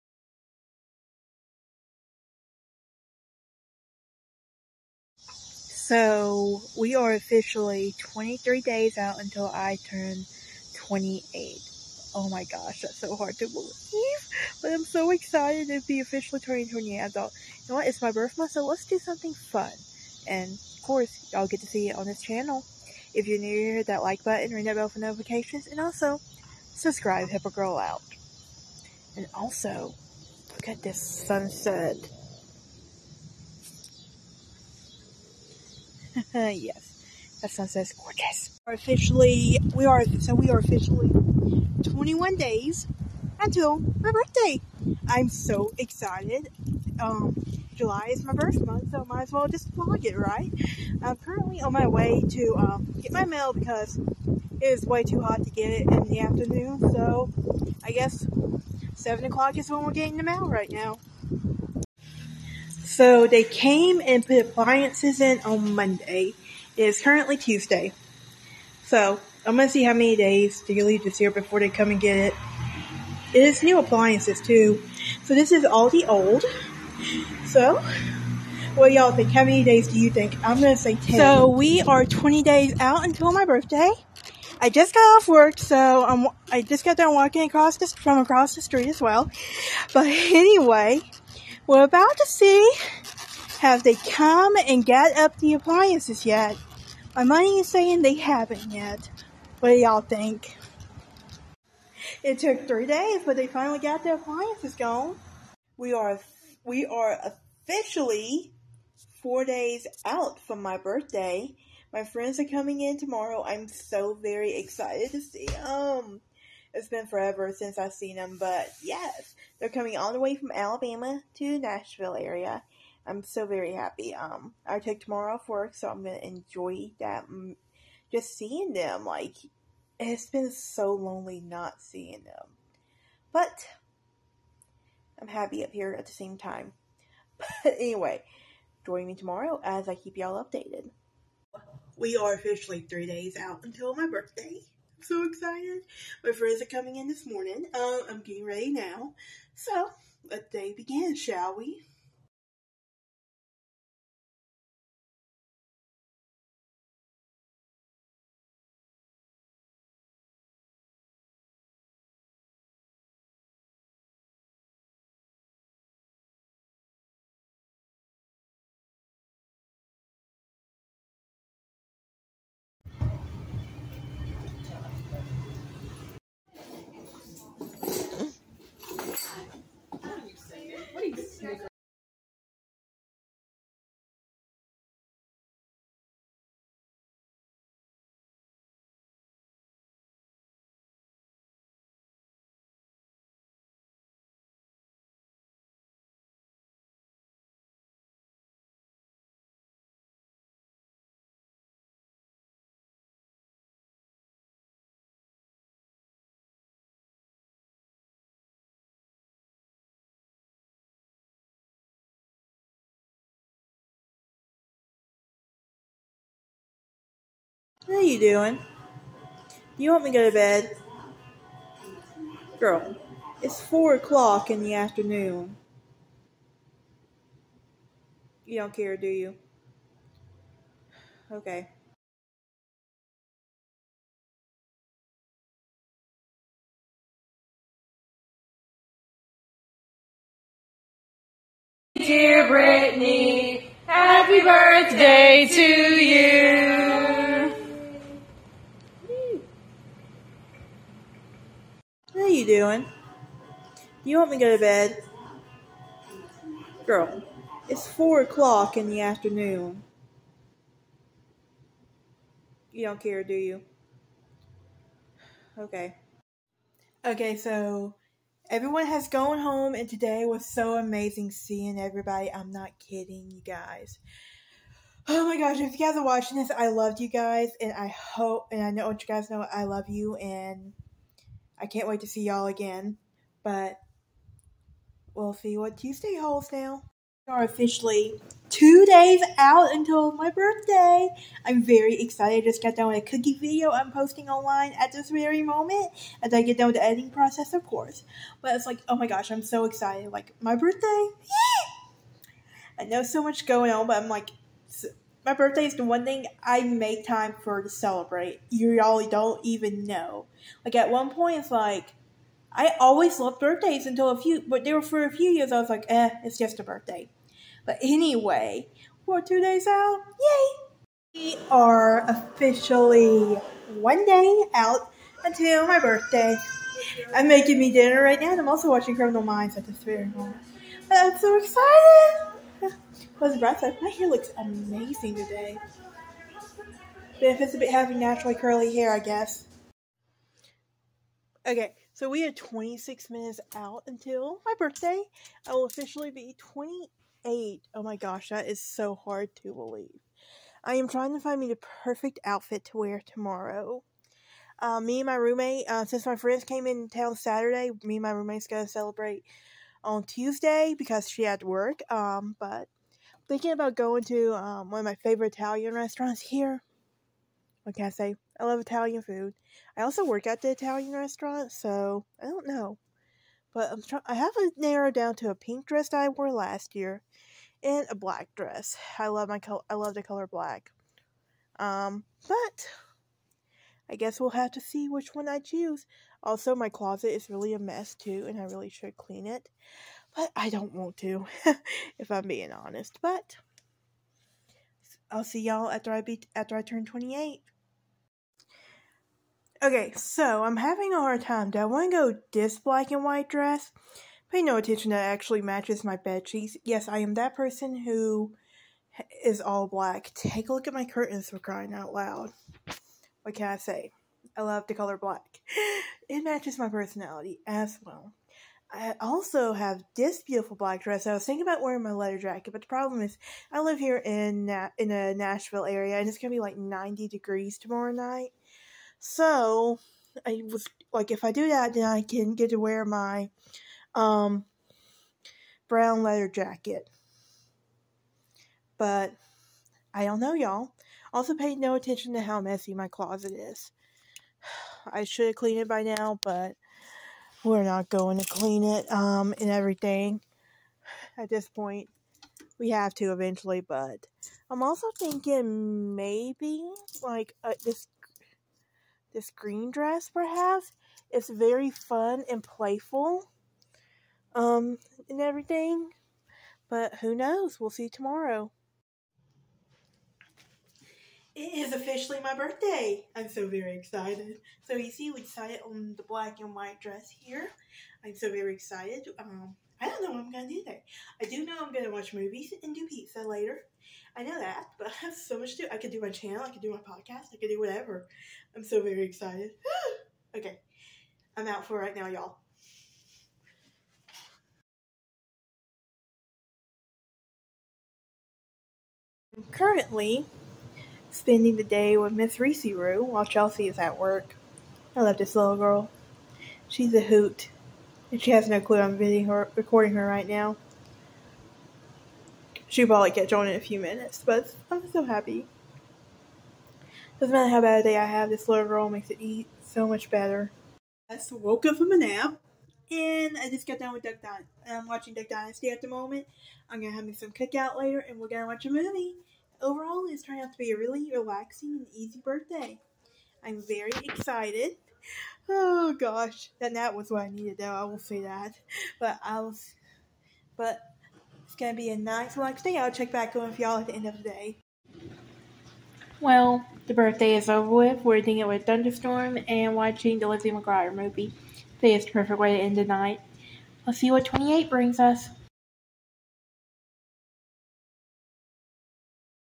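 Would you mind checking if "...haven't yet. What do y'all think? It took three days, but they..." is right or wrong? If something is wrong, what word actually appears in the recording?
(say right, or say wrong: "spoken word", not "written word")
right.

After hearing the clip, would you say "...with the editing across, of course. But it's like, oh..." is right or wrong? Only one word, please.
wrong.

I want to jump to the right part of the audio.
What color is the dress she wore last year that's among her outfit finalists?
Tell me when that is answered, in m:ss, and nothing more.
6:15.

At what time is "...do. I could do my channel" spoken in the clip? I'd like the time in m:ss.
8:05.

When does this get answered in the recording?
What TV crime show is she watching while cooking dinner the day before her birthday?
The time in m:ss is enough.
5:28.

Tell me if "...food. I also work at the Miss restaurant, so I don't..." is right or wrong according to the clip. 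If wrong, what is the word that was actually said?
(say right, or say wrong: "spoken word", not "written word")
wrong: "Italian", not "Miss".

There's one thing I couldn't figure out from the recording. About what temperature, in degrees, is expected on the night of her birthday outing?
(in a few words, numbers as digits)
90.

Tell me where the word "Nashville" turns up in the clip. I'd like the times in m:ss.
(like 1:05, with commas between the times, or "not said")
2:01, 7:05.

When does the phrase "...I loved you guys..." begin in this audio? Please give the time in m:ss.
4:36.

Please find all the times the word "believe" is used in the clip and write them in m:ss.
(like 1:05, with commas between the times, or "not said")
0:13, 5:49.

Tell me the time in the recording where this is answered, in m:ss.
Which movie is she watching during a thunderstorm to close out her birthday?
9:10.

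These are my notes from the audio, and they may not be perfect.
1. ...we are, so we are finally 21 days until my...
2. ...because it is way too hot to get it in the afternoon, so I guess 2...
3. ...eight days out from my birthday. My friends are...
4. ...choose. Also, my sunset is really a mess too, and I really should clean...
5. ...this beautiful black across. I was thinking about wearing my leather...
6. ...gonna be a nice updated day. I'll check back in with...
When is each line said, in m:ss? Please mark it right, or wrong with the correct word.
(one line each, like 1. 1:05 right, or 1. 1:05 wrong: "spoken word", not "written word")
1. 0:39 wrong: "officially", not "finally"
2. 0:53 wrong: "7", not "2"
3. 1:49 wrong: "four", not "eight"
4. 6:25 wrong: "closet", not "sunset"
5. 6:59 wrong: "dress", not "across"
6. 9:01 wrong: "relaxed", not "updated".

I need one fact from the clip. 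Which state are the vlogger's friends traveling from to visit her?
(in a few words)
Alabama.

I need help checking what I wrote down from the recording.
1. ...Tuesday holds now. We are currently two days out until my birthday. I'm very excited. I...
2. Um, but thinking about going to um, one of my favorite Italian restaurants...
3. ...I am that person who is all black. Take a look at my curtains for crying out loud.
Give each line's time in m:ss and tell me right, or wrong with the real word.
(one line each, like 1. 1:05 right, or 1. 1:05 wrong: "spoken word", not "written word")
1. 4:45 wrong: "officially", not "currently"
2. 6:01 right
3. 6:46 right.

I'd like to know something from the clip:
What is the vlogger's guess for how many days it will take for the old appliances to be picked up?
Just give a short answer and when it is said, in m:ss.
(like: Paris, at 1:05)
10, at 1:20.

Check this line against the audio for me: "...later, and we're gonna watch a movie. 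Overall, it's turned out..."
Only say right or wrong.
right.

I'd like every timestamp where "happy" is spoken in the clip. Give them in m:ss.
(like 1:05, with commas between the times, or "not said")
2:03, 2:15, 4:03, 8:35.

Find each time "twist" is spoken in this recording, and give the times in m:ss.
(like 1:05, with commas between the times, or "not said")
not said.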